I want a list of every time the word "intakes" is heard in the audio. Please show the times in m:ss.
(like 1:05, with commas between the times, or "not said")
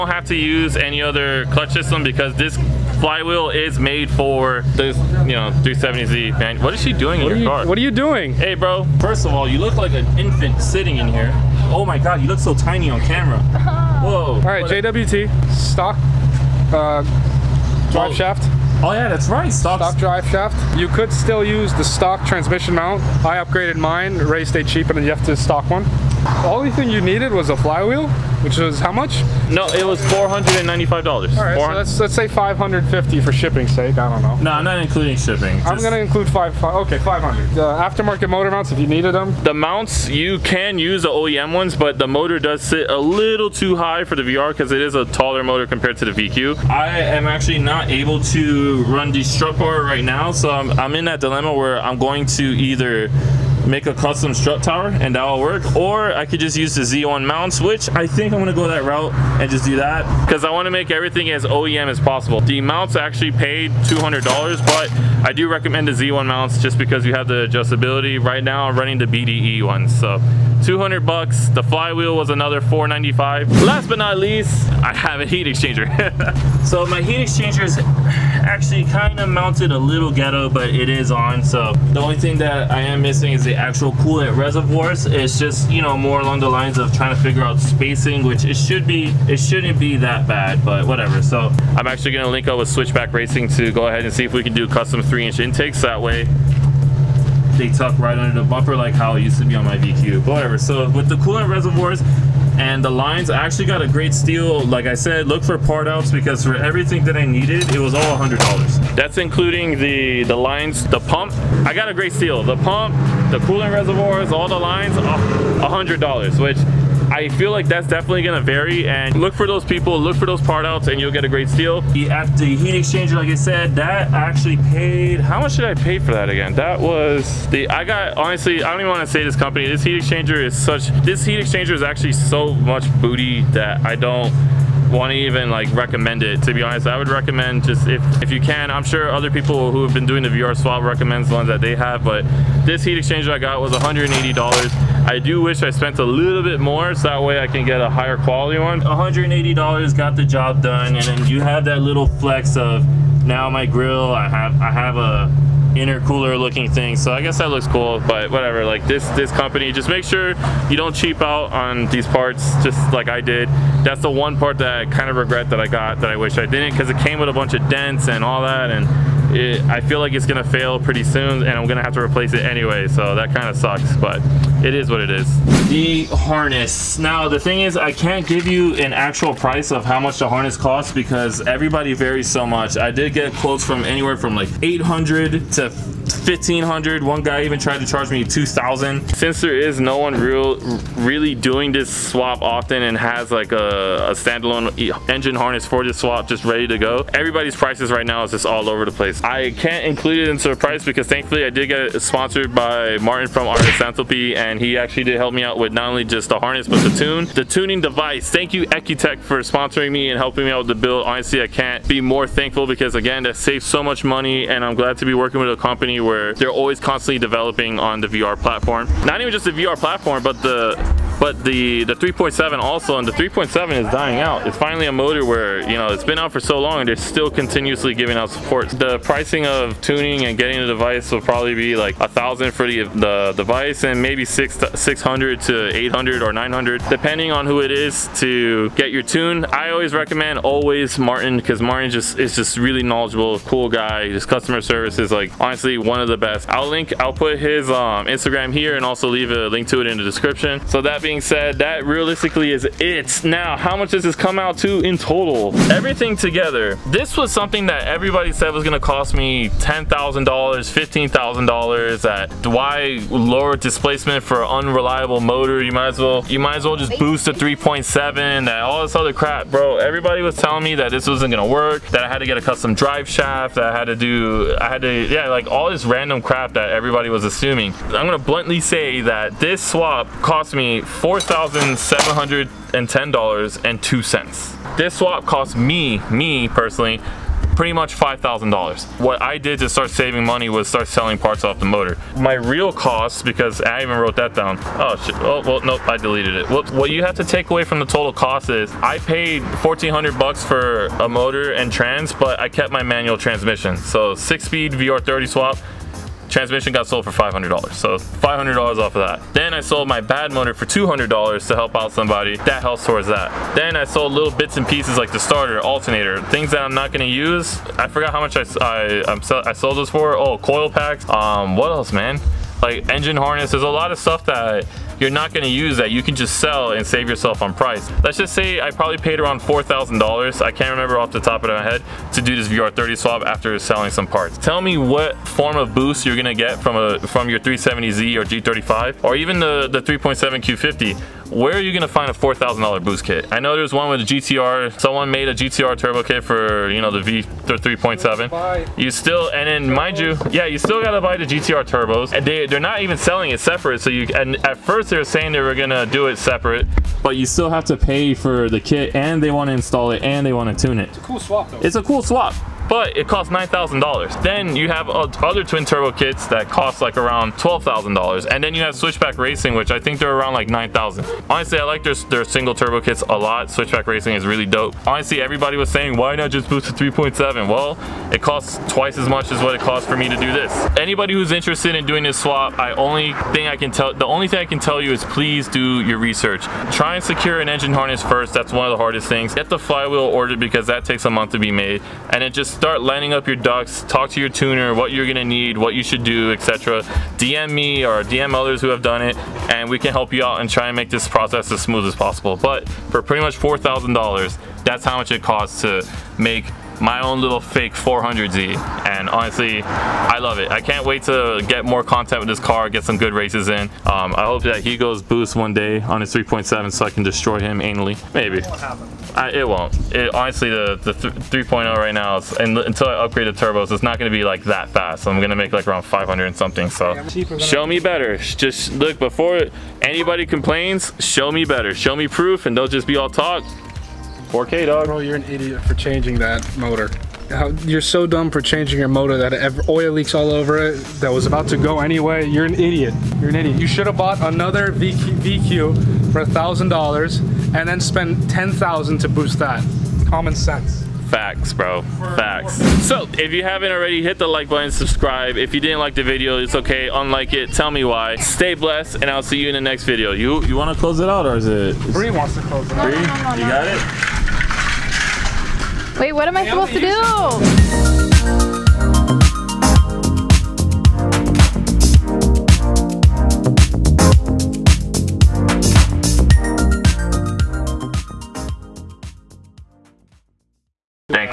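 1:35.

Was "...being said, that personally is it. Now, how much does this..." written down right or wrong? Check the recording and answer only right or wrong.
wrong.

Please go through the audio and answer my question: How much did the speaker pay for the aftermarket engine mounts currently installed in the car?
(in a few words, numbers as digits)
$200.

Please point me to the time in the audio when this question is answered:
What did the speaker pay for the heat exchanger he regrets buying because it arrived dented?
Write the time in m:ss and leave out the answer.
2:23.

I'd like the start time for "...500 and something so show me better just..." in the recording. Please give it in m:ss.
7:05.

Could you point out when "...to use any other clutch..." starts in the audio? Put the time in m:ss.
0:00.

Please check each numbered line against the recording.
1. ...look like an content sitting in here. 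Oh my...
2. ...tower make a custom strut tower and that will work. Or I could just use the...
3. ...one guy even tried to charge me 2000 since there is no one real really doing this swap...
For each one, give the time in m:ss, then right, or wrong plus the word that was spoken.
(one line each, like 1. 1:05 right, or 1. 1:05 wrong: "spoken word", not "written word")
1. 0:09 wrong: "infant", not "content"
2. 0:52 wrong: "either", not "tower"
3. 3:07 right.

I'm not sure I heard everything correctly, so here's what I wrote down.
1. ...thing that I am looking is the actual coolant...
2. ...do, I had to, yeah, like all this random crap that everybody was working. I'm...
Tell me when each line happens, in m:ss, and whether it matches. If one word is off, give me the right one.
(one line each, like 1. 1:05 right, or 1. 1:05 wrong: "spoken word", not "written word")
1. 1:22 wrong: "missing", not "looking"
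2. 4:33 wrong: "assuming", not "working".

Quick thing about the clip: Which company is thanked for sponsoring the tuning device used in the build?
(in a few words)
EcuTek.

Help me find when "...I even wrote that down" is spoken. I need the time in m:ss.
4:53.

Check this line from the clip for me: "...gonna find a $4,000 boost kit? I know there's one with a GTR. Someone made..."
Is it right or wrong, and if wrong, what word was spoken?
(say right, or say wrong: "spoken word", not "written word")
right.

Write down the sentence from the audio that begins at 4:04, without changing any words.
His customer service is like honestly one of the best.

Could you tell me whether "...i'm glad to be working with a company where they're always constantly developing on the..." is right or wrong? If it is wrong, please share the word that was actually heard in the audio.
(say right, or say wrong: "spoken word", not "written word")
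right.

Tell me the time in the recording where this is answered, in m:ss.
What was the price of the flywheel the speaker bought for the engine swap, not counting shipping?
0:30.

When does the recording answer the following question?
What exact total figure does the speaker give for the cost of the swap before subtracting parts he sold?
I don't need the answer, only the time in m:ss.
4:41.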